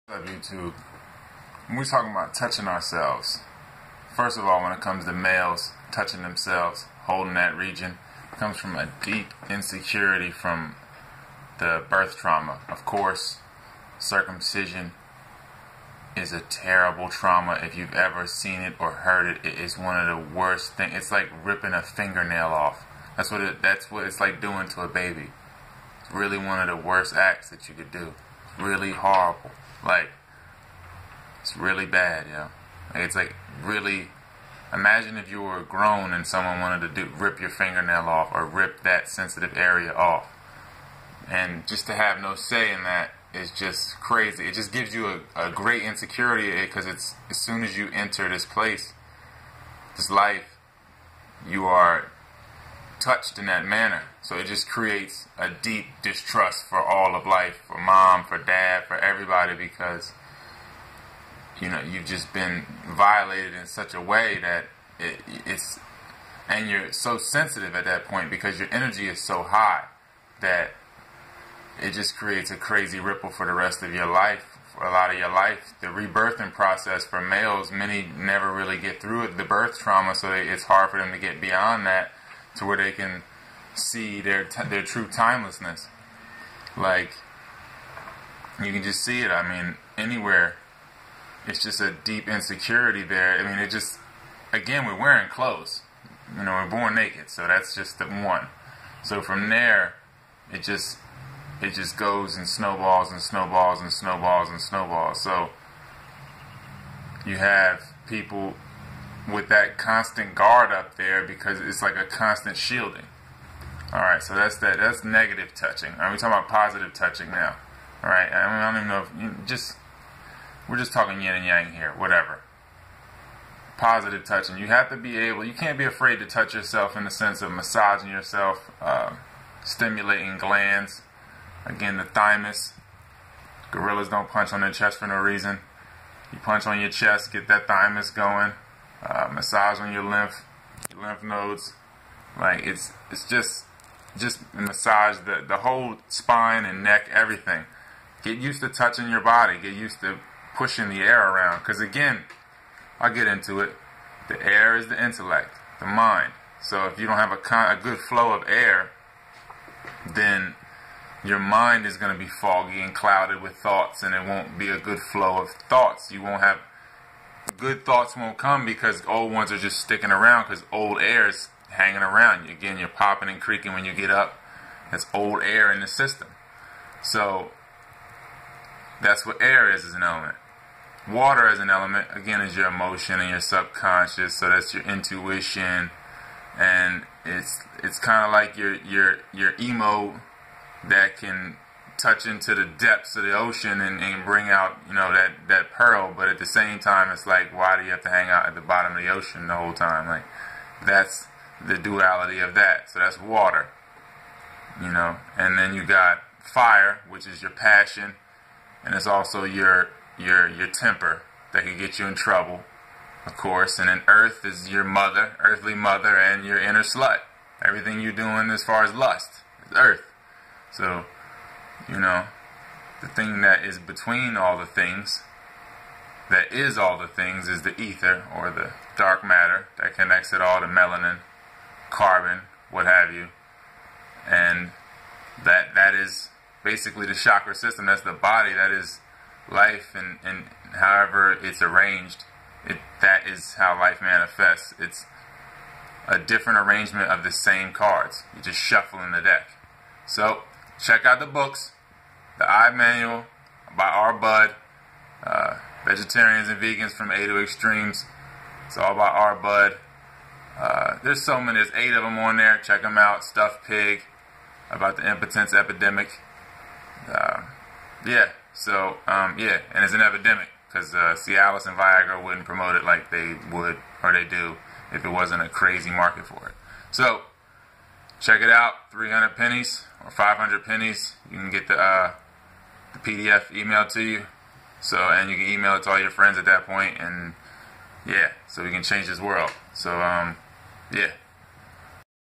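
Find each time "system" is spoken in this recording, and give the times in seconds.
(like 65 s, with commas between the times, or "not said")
175 s, 237 s.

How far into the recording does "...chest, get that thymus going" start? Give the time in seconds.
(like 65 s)
136 s.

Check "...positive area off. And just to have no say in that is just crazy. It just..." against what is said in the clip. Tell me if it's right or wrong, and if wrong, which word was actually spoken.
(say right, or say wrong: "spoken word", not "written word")
wrong: "sensitive", not "positive".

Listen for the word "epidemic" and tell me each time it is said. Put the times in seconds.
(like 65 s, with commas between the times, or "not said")
265 s, 270 s.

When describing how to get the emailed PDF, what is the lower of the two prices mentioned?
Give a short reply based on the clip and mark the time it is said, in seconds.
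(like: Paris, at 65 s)
300 pennies, at 278 s.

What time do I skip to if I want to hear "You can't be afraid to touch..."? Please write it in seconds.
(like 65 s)
125 s.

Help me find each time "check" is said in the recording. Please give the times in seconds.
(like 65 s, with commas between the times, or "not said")
250 s, 262 s, 278 s.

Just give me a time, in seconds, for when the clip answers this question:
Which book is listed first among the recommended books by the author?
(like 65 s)
252 s.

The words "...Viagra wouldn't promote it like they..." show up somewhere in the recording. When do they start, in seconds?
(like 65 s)
271 s.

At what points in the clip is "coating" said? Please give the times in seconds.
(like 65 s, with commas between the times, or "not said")
not said.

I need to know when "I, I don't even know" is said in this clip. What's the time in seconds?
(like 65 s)
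118 s.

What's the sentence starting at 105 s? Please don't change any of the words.
So you have people with that constant guard up there because it's like a constant shielding.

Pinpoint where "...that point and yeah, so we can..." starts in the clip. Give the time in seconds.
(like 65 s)
286 s.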